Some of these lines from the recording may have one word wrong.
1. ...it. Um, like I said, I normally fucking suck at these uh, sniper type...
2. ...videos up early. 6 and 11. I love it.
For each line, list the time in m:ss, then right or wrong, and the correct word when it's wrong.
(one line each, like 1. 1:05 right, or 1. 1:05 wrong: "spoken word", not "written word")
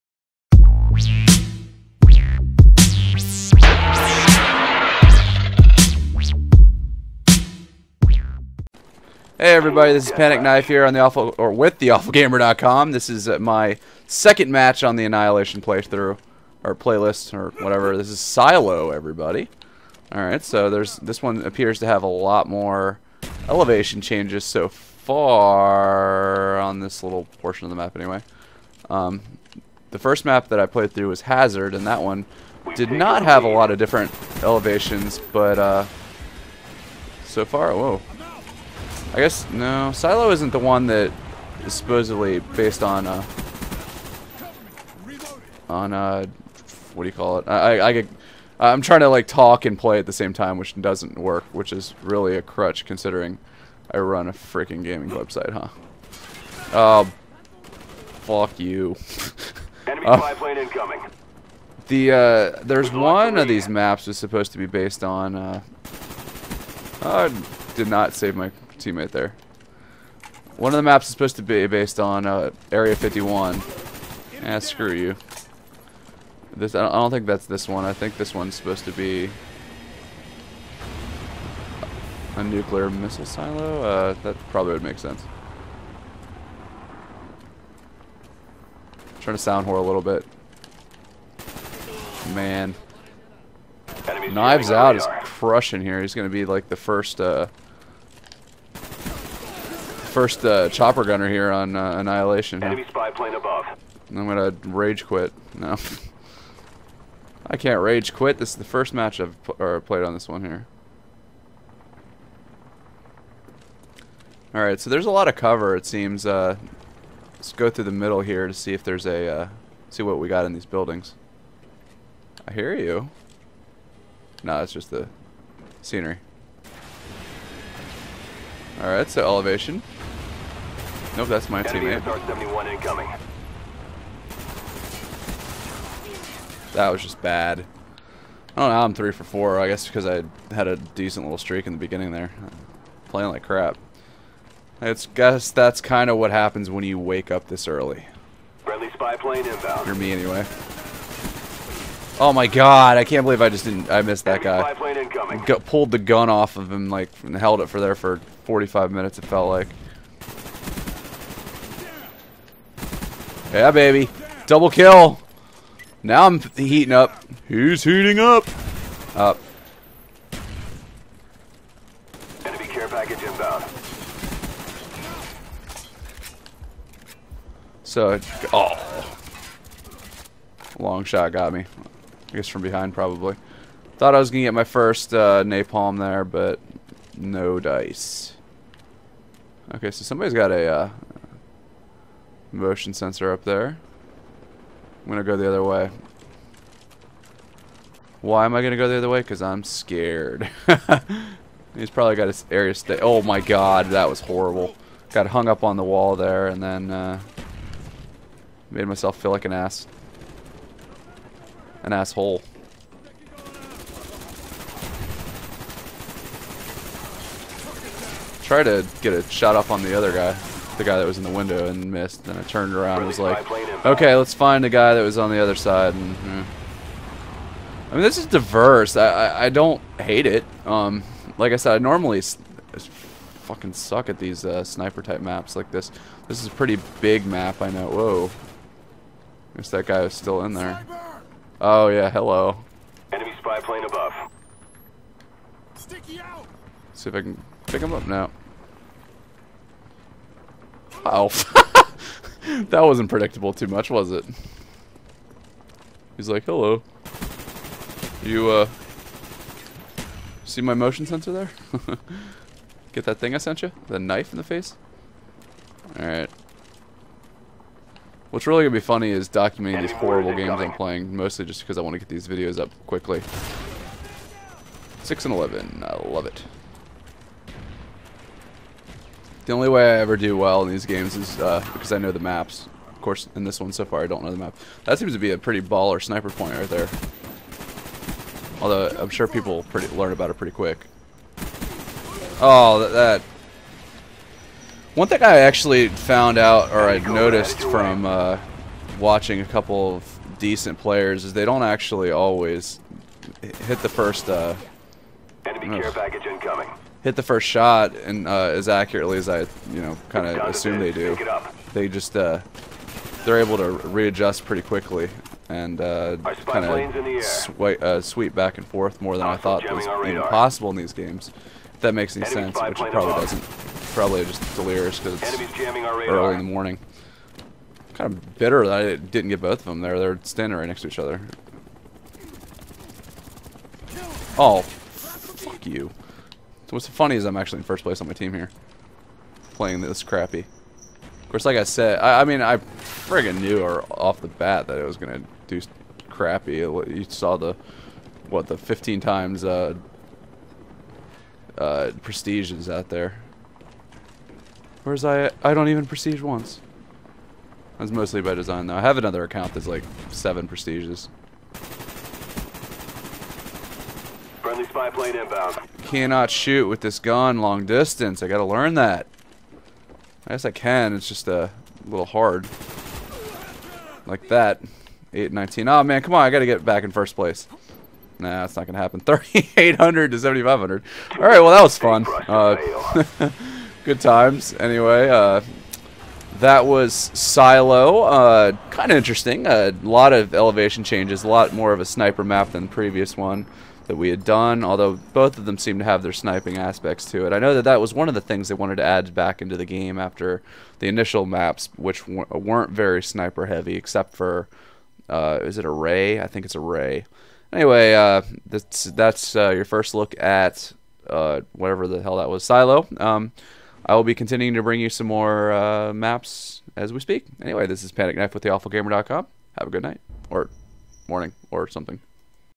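1. 3:50 right
2. 4:32 wrong: "quickly", not "early".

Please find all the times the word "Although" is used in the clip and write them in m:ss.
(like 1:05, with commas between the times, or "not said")
4:48, 6:34.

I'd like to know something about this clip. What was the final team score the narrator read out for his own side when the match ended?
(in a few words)
3,800.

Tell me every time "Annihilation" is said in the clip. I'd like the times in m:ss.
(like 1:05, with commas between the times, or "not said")
0:15, 1:41.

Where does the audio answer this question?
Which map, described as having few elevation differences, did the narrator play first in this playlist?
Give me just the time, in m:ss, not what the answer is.
0:31.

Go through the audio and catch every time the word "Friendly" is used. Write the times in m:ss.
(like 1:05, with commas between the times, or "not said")
2:28, 6:04.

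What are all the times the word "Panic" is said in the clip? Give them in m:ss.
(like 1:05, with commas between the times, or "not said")
0:10, 6:57.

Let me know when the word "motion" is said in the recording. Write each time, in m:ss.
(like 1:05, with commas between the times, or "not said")
3:12, 4:20.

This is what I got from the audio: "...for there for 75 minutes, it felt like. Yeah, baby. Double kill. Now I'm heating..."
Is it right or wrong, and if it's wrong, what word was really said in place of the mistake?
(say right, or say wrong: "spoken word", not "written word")
wrong: "45", not "75".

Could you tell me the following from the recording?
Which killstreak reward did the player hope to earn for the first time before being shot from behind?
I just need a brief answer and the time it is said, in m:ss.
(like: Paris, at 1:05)
napalm, at 3:05.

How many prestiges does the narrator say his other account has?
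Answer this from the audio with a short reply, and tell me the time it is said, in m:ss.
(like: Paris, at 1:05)
7, at 6:00.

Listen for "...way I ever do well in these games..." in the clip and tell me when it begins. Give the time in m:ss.
4:39.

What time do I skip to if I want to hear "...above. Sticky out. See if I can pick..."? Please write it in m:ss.
4:03.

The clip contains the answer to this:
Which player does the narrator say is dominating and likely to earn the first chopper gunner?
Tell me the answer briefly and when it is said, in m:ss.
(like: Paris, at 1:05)
Knives Out, at 1:34.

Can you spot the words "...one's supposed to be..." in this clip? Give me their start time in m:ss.
1:18.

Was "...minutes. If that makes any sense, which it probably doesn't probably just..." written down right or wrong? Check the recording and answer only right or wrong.
wrong.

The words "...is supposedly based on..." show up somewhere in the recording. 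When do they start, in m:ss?
0:41.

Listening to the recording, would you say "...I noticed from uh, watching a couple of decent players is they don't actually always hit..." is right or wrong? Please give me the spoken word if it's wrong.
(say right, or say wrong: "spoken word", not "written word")
right.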